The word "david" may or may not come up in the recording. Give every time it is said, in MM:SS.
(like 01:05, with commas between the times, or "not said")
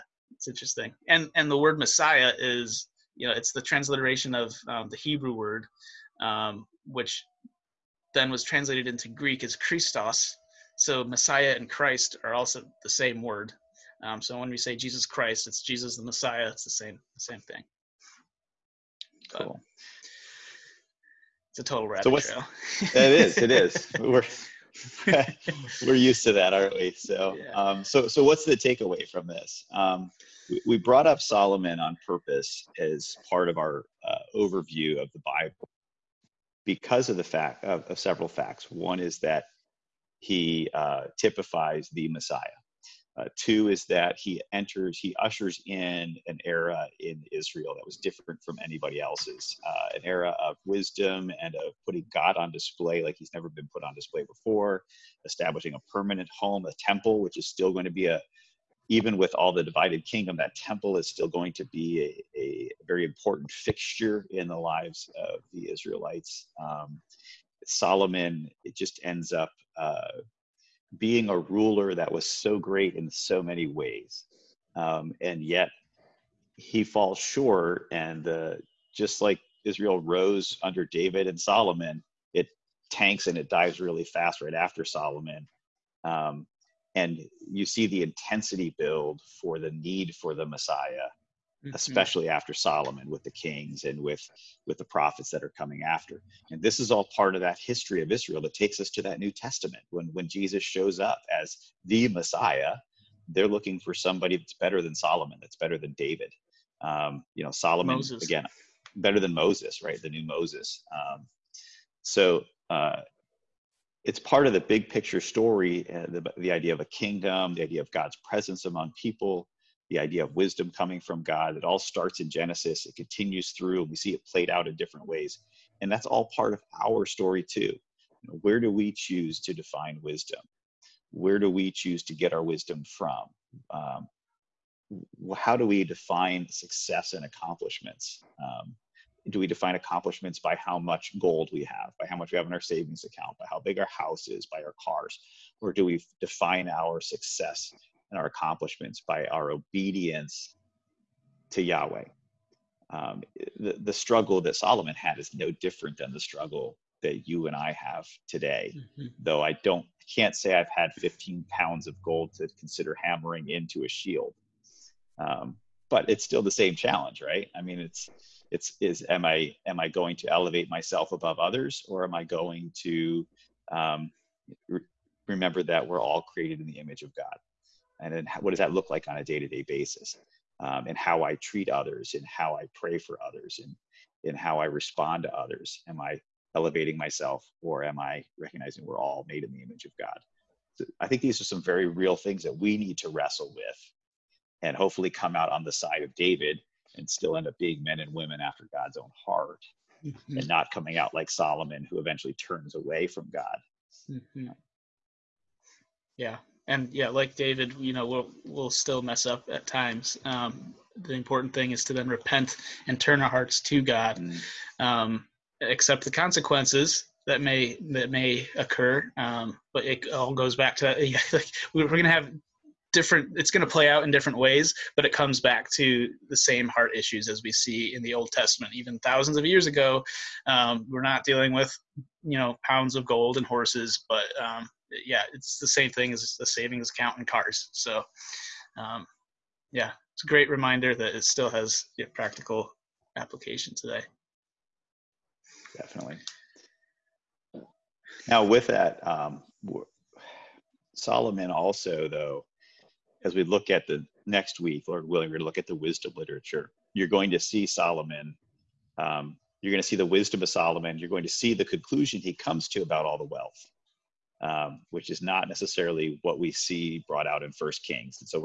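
01:20, 01:45, 03:16, 03:27.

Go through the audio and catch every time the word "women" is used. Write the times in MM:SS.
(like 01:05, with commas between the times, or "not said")
03:18.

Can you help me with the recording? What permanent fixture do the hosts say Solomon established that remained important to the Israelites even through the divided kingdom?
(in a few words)
a temple.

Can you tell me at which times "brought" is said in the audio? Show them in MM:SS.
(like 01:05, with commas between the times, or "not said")
00:30, 04:27.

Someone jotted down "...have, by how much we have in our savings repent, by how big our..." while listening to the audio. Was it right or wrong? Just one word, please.
wrong.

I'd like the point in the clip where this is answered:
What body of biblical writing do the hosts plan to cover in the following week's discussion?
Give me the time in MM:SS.
04:15.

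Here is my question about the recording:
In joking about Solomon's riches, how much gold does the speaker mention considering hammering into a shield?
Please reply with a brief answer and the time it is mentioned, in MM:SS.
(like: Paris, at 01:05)
15 pounds, at 02:40.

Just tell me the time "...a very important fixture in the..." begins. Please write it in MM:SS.
01:02.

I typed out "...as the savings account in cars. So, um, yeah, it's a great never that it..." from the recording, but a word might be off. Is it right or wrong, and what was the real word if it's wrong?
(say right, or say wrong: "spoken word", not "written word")
wrong: "reminder", not "never".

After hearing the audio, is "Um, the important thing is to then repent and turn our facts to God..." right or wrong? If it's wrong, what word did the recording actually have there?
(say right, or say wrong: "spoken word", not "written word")
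wrong: "hearts", not "facts".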